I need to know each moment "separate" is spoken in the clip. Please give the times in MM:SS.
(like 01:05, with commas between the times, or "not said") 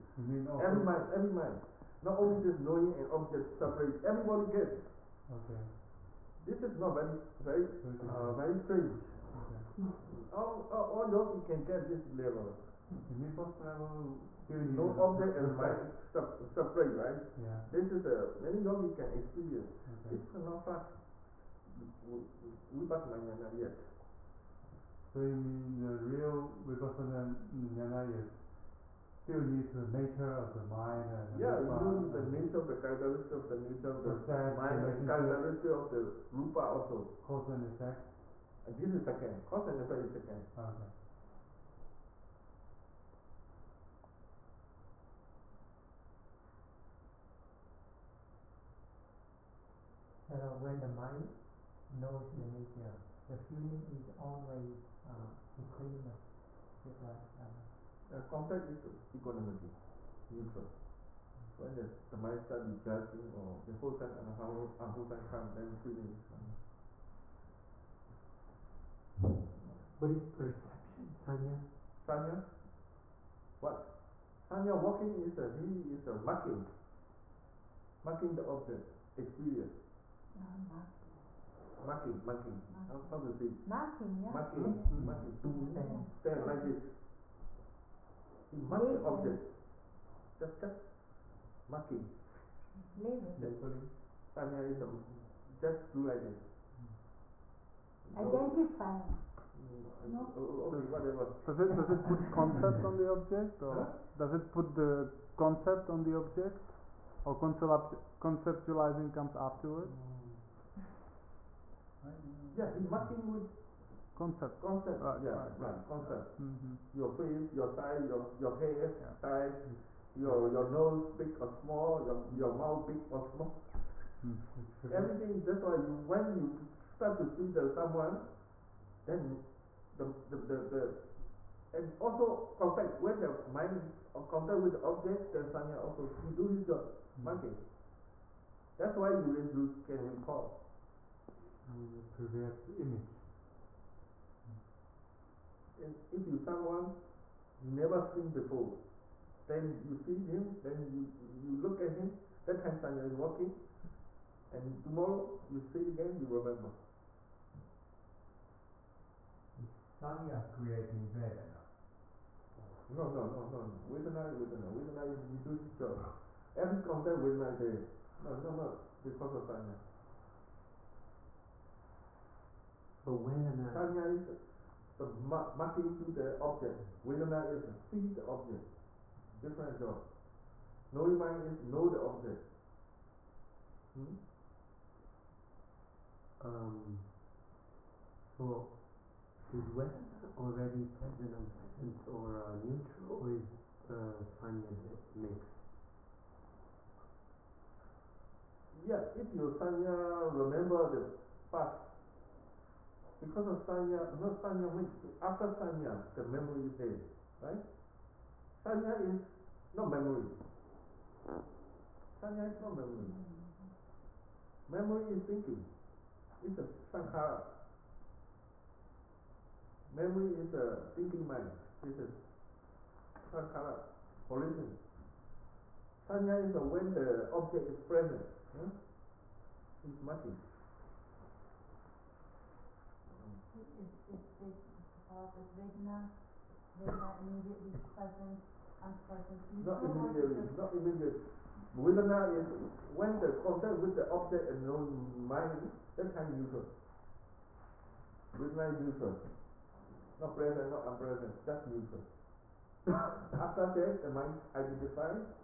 00:03, 00:16.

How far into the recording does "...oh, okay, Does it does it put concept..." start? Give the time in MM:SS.
01:40.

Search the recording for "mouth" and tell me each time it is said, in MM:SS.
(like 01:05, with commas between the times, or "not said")
02:02.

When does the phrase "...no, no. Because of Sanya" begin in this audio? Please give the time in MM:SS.
02:48.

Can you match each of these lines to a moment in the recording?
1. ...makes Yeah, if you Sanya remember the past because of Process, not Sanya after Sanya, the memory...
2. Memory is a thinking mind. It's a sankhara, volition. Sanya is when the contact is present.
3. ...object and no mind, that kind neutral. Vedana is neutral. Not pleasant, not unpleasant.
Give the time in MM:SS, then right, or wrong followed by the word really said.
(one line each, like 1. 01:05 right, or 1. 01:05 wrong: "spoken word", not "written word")
1. 03:15 wrong: "Sanya", not "Process"
2. 03:39 wrong: "object", not "contact"
3. 04:04 wrong: "present", not "pleasant".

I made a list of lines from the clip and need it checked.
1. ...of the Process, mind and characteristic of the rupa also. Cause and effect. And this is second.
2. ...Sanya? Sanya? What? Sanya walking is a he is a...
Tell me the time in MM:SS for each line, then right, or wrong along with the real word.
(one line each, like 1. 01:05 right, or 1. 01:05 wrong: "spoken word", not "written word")
1. 00:33 right
2. 01:11 right.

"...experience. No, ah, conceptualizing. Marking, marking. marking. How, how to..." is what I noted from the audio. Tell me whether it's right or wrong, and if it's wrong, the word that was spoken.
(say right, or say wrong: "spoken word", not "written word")
wrong: "marking", not "conceptualizing".